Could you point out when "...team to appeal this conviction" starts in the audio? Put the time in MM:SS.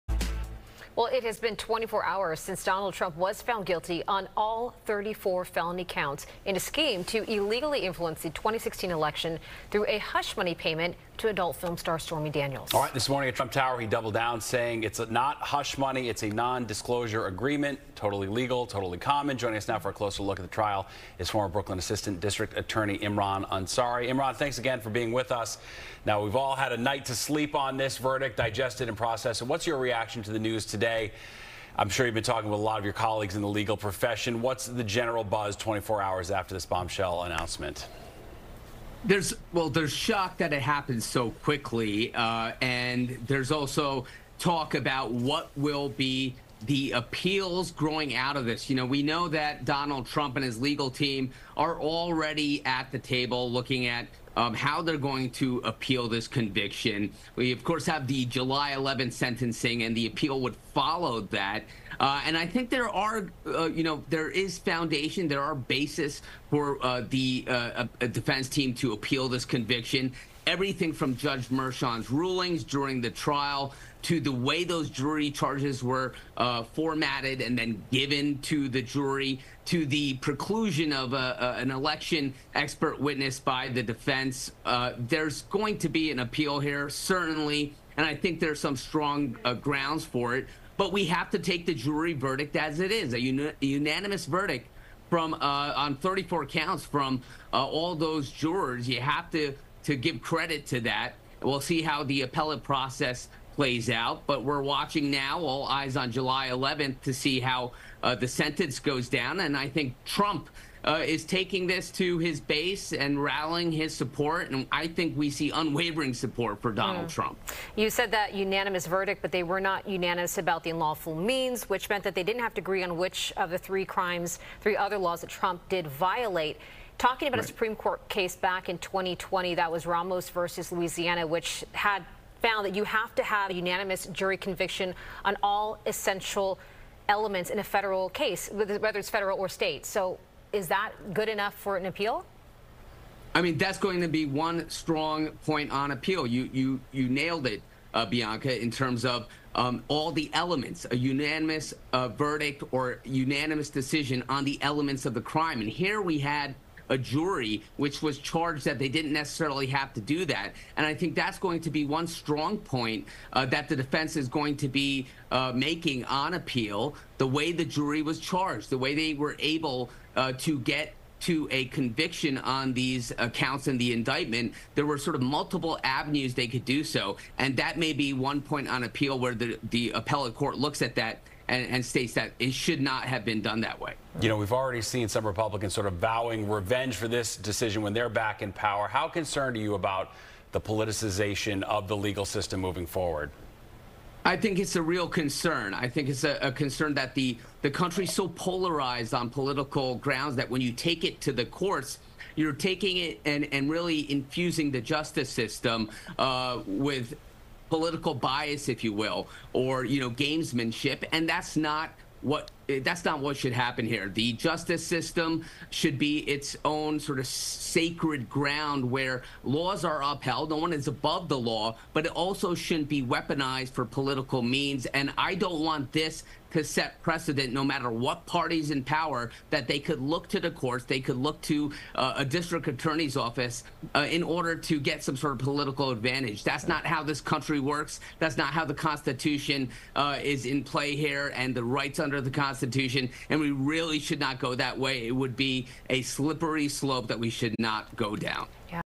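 01:08.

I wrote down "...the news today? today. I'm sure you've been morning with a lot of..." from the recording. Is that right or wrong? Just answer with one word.
wrong.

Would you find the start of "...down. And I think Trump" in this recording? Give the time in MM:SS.
01:49.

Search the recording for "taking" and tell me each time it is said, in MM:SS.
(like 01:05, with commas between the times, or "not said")
01:51, 03:22.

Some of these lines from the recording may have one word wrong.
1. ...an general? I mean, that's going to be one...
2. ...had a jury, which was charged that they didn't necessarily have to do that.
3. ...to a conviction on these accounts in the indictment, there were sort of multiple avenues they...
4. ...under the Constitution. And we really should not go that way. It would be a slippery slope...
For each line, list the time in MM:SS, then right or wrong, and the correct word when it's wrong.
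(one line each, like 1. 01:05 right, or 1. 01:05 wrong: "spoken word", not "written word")
1. 02:21 wrong: "appeal", not "general"
2. 02:36 right
3. 02:51 right
4. 04:01 right.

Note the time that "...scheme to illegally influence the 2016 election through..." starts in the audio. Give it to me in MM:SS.
00:06.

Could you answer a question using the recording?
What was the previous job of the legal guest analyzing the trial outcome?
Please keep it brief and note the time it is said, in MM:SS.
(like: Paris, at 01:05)
Former Brooklyn Assistant District Attorney, at 00:21.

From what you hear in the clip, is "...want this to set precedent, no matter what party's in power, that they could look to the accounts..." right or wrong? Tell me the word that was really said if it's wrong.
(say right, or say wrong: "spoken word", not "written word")
wrong: "courts", not "accounts".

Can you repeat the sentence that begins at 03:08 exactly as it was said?
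How concerned are you about the politicization of the legal system moving forward?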